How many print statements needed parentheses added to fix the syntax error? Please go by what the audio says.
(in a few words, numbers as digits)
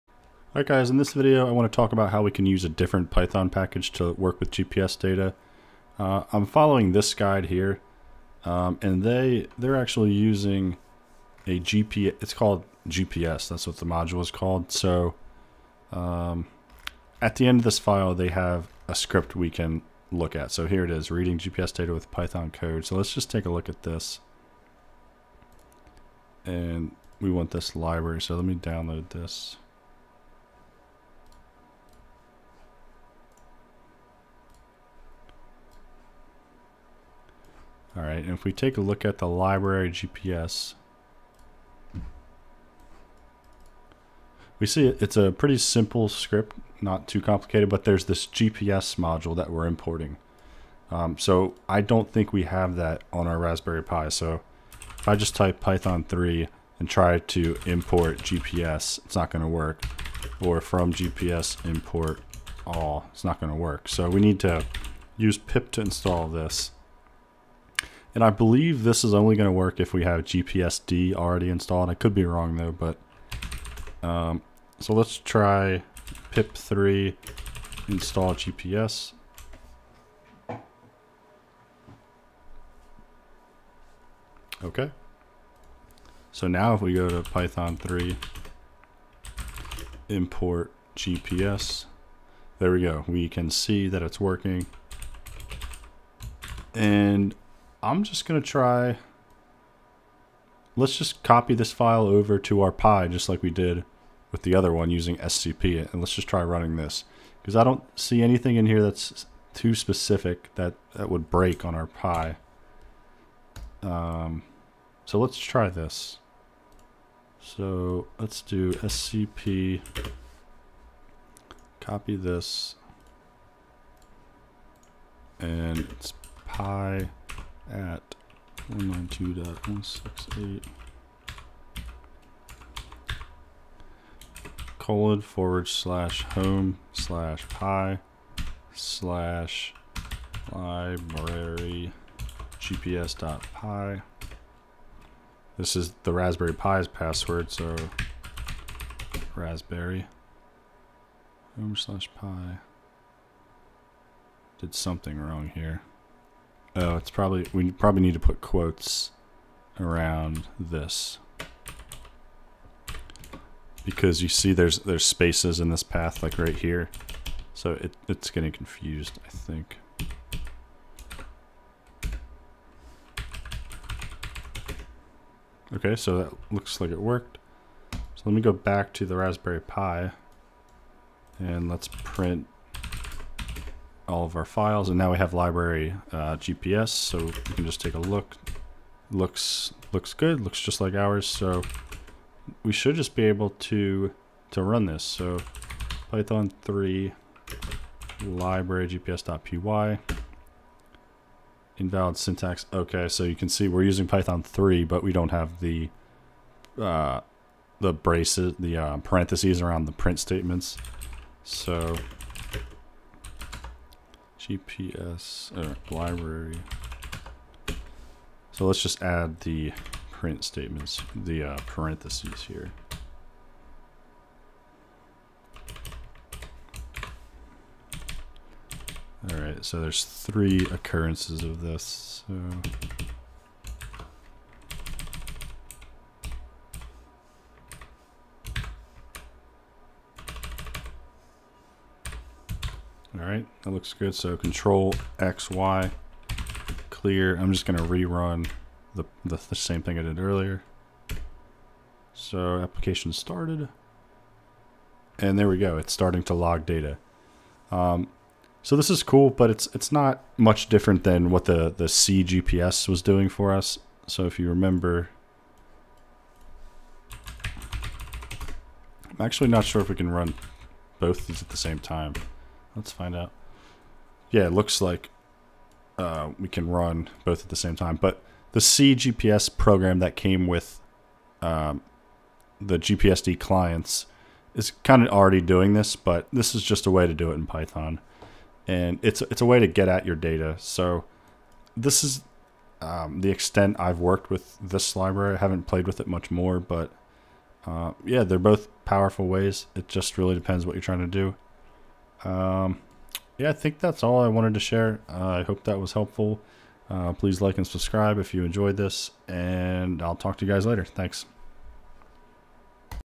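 3.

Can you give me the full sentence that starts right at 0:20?
So here it is, reading GPS data with Python code.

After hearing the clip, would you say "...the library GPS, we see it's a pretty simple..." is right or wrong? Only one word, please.
right.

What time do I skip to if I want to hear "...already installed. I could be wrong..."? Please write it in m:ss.
1:11.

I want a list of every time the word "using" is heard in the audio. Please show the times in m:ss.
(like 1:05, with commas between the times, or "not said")
0:10, 1:44, 3:23.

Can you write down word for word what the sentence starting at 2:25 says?
This is the Raspberry Pi's password, so raspberry home slash pi.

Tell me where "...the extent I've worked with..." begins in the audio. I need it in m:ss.
4:53.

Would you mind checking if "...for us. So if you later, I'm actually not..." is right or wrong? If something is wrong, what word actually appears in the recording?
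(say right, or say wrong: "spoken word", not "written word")
wrong: "remember", not "later".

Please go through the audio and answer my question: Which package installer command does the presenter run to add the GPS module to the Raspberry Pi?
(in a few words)
pip3.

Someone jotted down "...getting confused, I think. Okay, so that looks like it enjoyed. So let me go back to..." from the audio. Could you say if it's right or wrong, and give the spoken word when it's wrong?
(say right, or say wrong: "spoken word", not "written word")
wrong: "worked", not "enjoyed".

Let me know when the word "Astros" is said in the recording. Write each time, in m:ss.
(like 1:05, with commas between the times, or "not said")
not said.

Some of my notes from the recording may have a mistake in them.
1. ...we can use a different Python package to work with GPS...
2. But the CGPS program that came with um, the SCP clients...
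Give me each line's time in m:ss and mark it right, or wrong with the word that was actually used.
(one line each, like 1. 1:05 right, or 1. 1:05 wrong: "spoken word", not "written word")
1. 0:02 right
2. 4:37 wrong: "GPSD", not "SCP".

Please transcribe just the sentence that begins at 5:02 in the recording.
Um, yeah, I think that's all I wanted to share.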